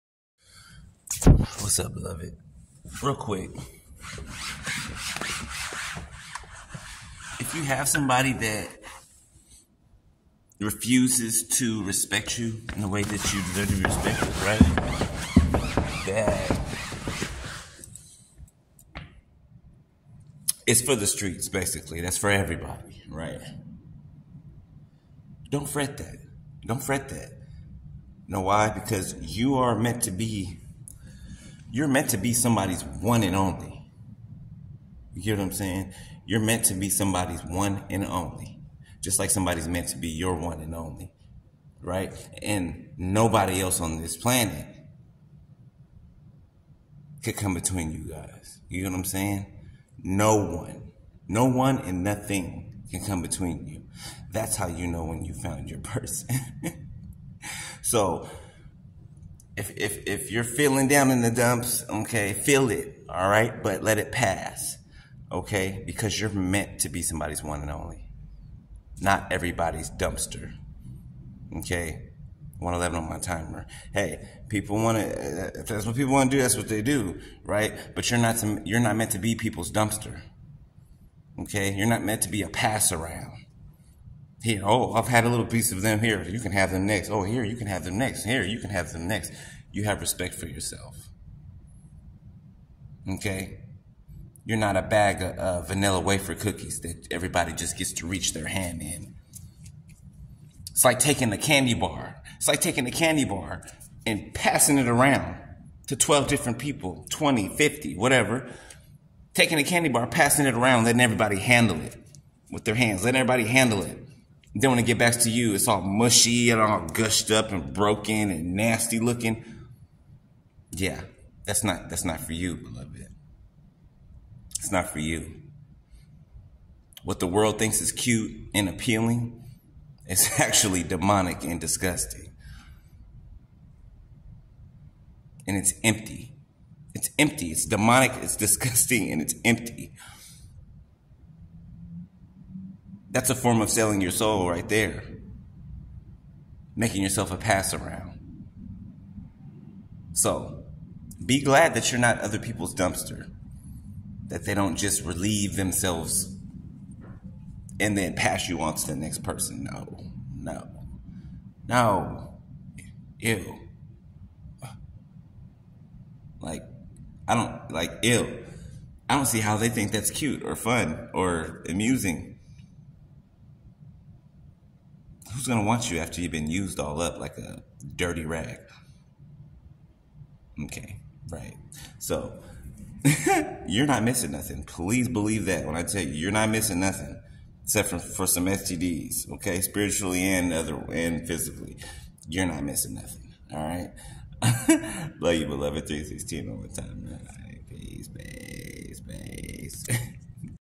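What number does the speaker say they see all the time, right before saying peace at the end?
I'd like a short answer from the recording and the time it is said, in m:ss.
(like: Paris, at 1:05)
316, at 3:15.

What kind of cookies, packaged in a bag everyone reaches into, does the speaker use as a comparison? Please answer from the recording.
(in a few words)
vanilla wafer.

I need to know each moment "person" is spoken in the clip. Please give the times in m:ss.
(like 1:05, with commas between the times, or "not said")
0:55, 2:39.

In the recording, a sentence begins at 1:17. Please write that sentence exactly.
But you're not, to, you're not meant to be people's dumpster, okay?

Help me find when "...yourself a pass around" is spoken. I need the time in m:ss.
2:27.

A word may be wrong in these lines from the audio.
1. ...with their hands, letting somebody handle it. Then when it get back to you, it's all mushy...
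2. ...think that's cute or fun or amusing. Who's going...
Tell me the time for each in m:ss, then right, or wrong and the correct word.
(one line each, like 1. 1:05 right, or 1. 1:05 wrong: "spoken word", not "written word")
1. 1:52 wrong: "everybody", not "somebody"
2. 2:49 right.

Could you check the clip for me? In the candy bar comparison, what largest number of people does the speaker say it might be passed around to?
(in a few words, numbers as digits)
50.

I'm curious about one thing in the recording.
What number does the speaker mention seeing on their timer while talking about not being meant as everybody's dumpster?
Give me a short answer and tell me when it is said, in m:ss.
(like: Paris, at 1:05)
111, at 1:12.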